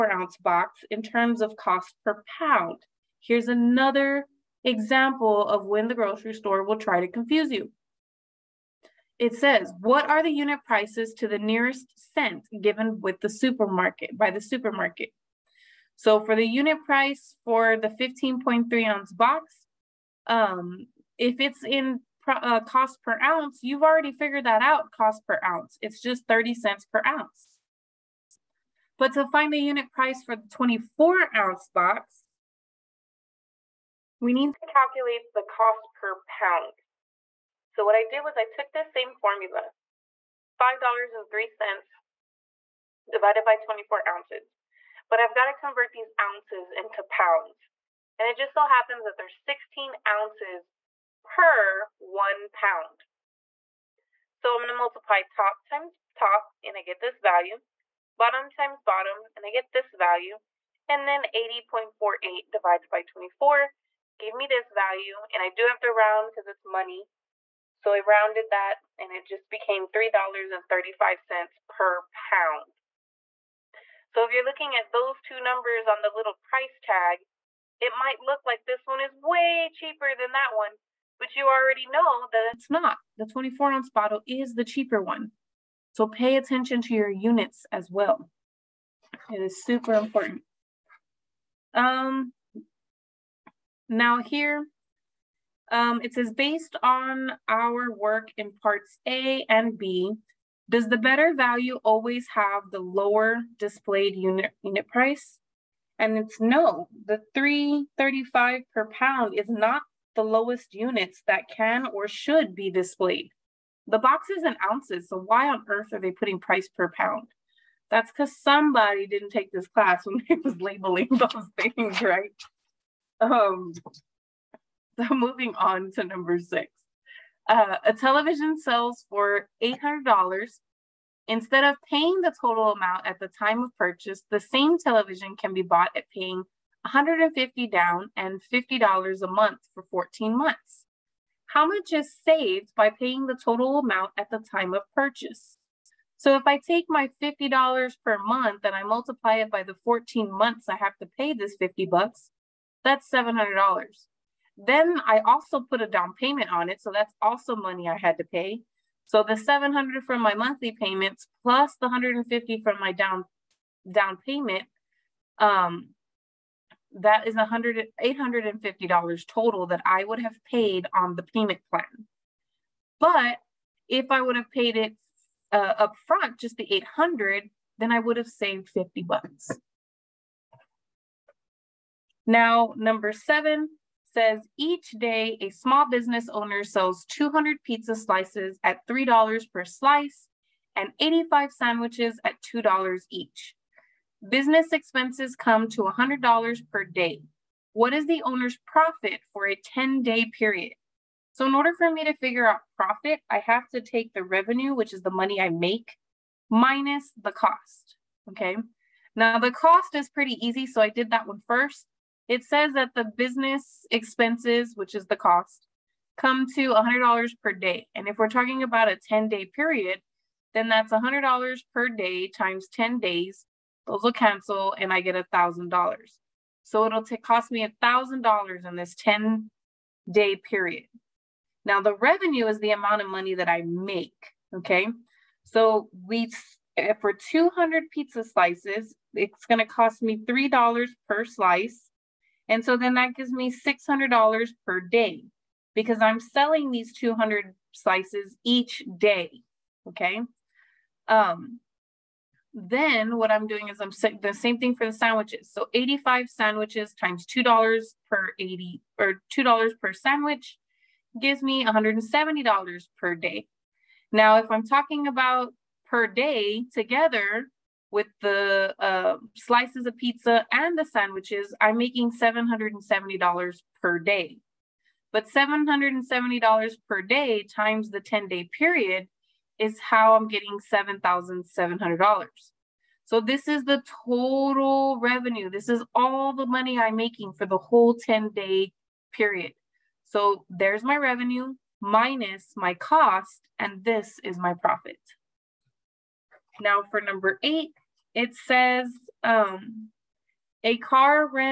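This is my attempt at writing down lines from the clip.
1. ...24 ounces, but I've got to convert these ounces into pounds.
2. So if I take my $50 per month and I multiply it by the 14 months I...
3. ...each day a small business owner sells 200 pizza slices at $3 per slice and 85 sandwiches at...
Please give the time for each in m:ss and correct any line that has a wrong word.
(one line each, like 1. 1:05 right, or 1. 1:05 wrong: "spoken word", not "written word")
1. 0:43 right
2. 2:26 right
3. 3:04 right.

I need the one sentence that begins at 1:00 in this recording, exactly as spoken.
And then 80.48 divided by 24 gave me this value.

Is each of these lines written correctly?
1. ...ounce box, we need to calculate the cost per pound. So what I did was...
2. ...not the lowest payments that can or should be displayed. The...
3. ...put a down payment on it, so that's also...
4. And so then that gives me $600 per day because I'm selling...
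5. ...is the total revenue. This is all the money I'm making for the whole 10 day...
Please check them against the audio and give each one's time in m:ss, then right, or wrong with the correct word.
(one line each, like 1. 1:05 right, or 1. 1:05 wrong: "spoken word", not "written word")
1. 0:31 right
2. 1:49 wrong: "units", not "payments"
3. 2:35 right
4. 4:02 right
5. 4:43 right.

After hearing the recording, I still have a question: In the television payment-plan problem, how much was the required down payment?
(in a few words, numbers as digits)
$150.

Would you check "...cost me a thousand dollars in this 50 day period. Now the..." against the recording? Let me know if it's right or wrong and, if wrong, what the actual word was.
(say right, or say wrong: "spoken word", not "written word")
wrong: "10", not "50".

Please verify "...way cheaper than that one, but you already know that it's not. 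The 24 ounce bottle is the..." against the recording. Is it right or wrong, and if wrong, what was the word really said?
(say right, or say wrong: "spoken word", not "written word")
right.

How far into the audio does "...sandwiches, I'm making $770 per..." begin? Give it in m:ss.
4:30.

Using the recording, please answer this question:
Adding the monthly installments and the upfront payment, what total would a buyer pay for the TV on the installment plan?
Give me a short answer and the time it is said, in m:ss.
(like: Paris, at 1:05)
$850, at 2:48.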